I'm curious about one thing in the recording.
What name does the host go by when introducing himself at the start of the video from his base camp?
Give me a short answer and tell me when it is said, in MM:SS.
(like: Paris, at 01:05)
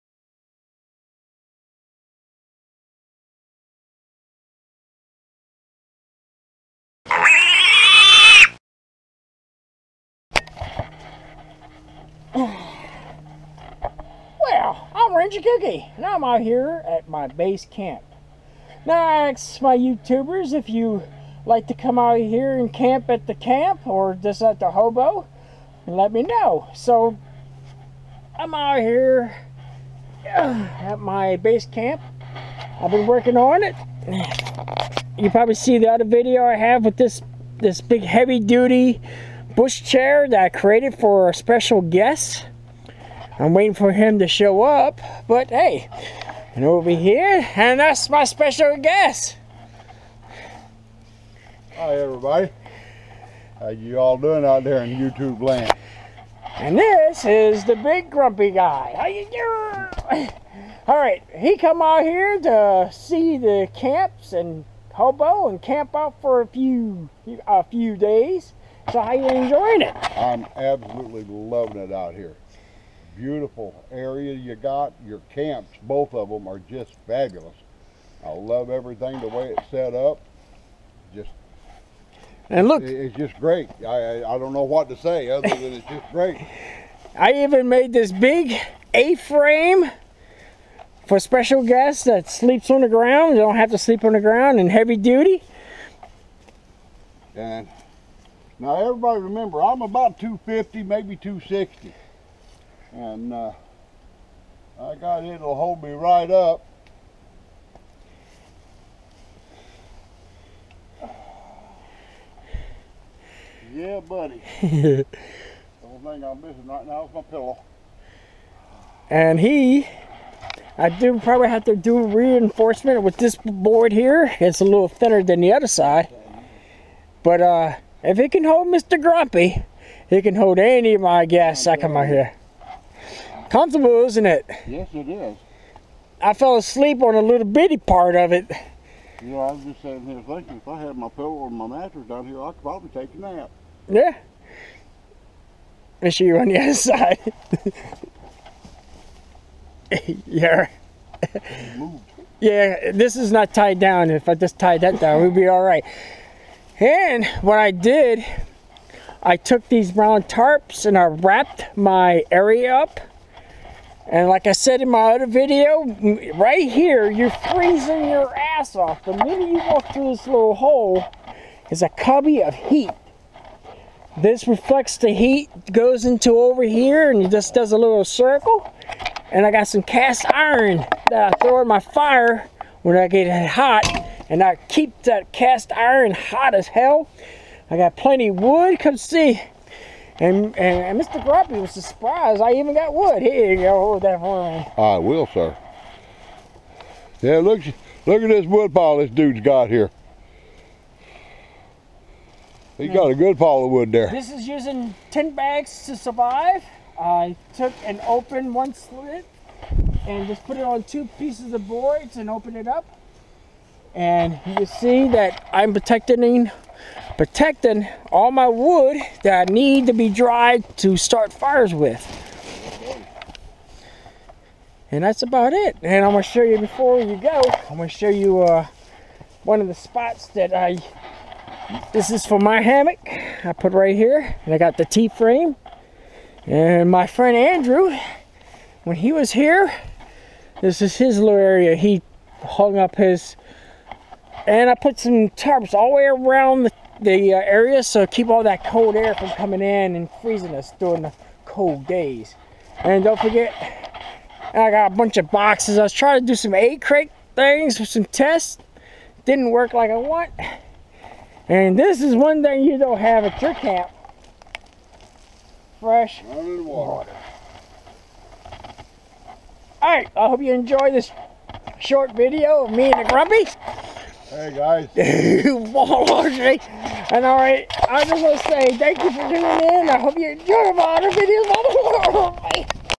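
Ranger Kooky, at 00:15.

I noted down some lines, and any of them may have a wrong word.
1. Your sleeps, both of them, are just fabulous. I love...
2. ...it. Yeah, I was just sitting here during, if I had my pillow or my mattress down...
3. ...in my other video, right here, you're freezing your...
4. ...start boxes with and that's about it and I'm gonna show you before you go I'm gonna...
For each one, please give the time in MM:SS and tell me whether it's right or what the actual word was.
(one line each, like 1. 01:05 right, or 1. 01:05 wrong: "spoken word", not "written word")
1. 01:15 wrong: "camps", not "sleeps"
2. 02:18 wrong: "thinking", not "during"
3. 02:44 right
4. 03:40 wrong: "fires", not "boxes".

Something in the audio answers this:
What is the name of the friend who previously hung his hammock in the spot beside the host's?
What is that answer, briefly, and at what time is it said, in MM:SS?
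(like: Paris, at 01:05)
Andrew, at 03:57.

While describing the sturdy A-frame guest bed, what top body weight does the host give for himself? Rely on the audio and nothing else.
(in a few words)
260.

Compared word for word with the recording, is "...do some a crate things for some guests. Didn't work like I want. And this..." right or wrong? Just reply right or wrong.
wrong.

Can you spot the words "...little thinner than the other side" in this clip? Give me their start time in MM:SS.
02:04.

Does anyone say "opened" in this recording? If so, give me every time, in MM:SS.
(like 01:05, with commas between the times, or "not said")
03:28, 03:32.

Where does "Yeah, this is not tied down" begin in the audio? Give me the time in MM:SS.
02:32.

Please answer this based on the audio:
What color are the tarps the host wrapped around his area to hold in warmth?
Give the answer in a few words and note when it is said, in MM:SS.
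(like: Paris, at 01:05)
brown, at 02:39.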